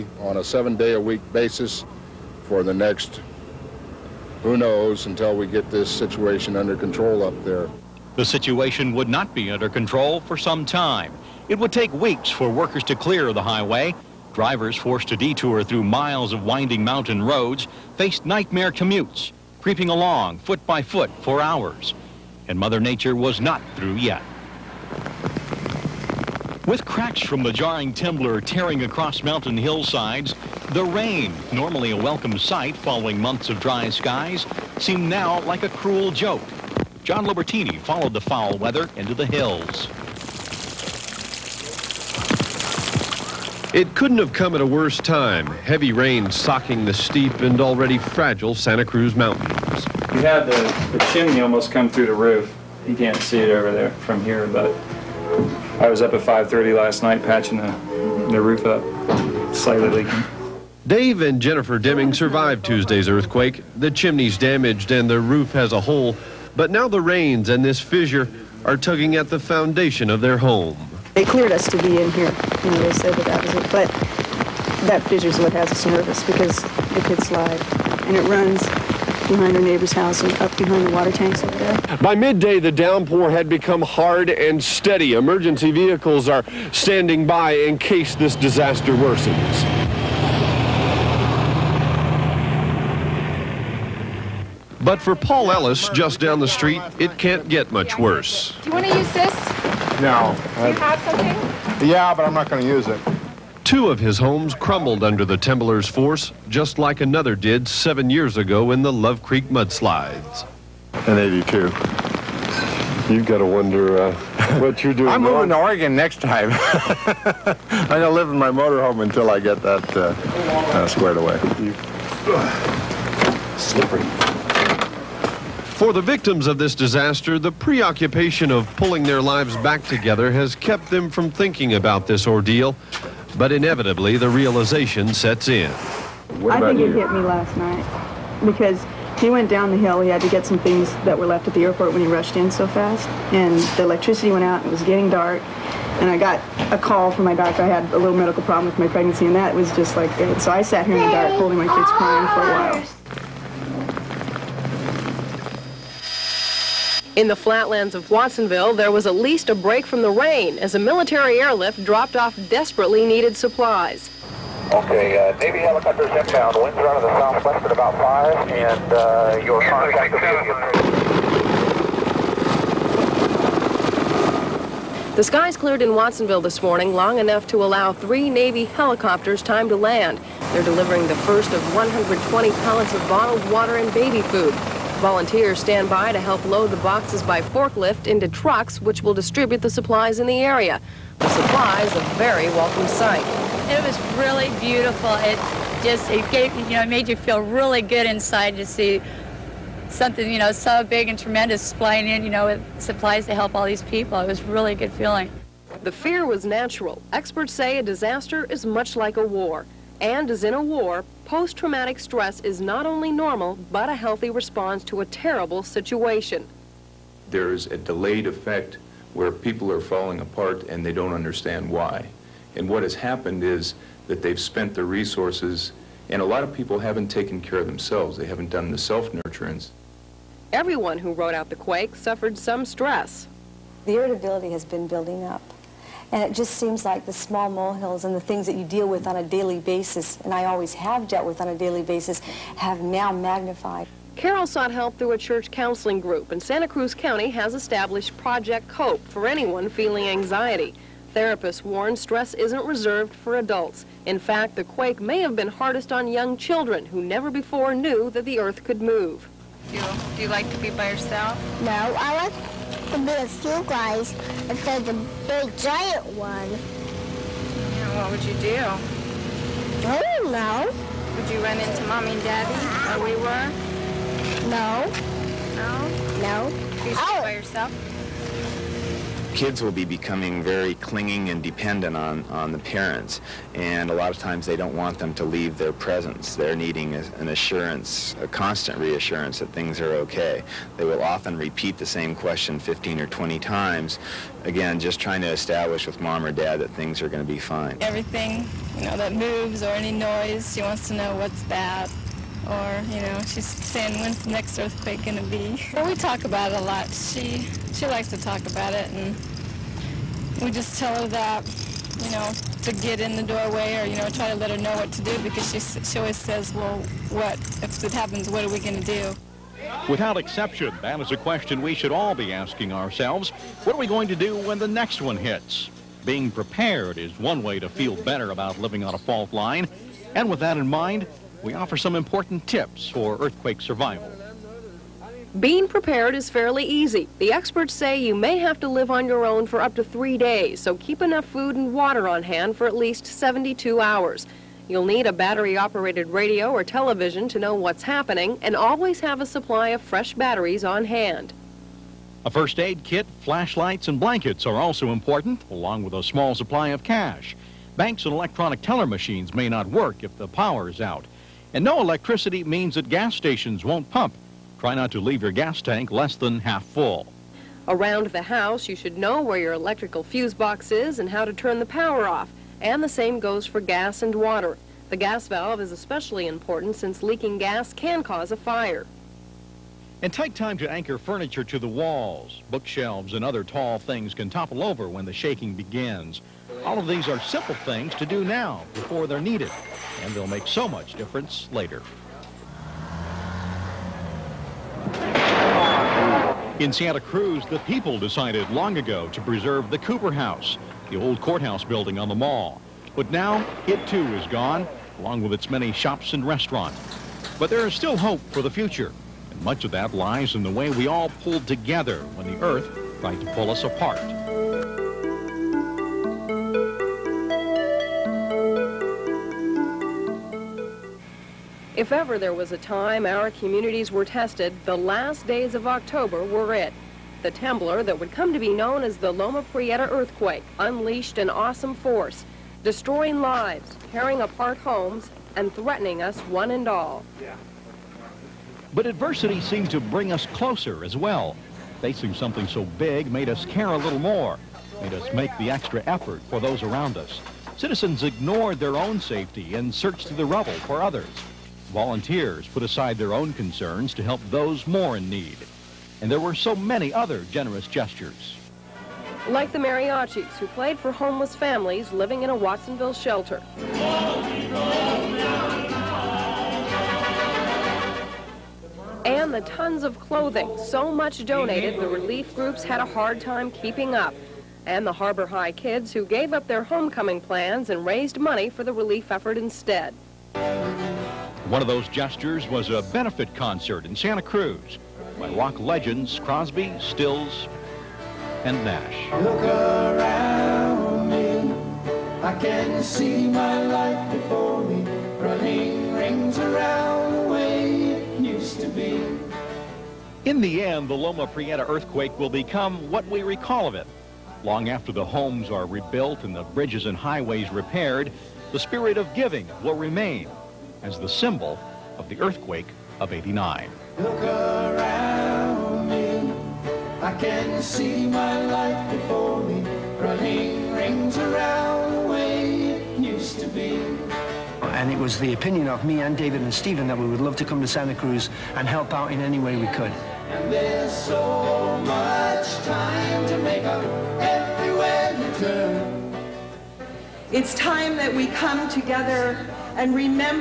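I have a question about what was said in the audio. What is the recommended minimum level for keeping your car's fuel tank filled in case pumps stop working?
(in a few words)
half full.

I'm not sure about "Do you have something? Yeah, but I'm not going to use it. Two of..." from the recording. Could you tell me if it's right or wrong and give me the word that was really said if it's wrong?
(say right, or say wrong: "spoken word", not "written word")
right.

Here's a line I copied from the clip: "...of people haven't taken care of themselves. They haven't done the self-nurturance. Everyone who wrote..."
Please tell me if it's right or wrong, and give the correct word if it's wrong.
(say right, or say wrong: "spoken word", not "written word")
right.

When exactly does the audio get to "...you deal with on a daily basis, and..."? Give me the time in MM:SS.
03:58.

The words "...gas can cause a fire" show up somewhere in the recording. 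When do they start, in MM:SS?
06:17.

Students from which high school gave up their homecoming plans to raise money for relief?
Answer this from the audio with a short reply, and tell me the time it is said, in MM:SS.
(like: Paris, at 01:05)
Harbor High, at 07:54.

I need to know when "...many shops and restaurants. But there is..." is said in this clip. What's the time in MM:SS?
06:45.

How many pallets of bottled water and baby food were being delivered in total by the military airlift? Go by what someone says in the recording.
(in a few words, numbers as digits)
120.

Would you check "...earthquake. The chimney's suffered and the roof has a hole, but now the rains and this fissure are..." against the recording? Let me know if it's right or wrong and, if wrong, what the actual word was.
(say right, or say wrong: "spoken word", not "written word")
wrong: "damaged", not "suffered".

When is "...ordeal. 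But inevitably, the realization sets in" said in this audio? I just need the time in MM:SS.
02:12.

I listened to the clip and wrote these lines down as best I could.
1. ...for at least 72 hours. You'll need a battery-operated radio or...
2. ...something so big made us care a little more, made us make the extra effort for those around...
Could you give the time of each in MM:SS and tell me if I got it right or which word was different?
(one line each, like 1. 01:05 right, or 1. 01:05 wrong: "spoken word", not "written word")
1. 05:42 right
2. 07:22 right.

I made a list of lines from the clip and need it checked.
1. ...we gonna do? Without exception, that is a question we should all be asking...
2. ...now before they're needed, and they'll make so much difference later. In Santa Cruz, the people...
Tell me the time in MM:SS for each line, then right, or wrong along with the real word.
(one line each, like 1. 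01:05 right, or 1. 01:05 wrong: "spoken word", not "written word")
1. 05:18 right
2. 06:28 right.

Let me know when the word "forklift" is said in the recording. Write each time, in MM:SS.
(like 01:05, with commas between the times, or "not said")
03:07.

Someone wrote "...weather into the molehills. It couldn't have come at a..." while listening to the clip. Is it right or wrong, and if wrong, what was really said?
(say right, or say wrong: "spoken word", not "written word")
wrong: "hills", not "molehills".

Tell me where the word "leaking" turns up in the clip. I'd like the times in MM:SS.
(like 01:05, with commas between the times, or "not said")
00:59, 06:17.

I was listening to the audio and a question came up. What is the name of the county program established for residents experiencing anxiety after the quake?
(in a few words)
Project COPE.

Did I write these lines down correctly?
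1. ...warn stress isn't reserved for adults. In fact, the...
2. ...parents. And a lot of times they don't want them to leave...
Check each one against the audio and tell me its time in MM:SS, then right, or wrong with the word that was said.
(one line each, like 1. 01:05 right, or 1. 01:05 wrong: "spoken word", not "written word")
1. 04:11 right
2. 04:42 right.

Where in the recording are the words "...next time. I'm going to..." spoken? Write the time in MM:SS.
01:55.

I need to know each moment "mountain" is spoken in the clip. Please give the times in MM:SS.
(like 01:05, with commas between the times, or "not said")
00:16, 00:29, 00:49.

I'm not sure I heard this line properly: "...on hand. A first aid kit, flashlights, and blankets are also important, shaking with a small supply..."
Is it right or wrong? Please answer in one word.
wrong.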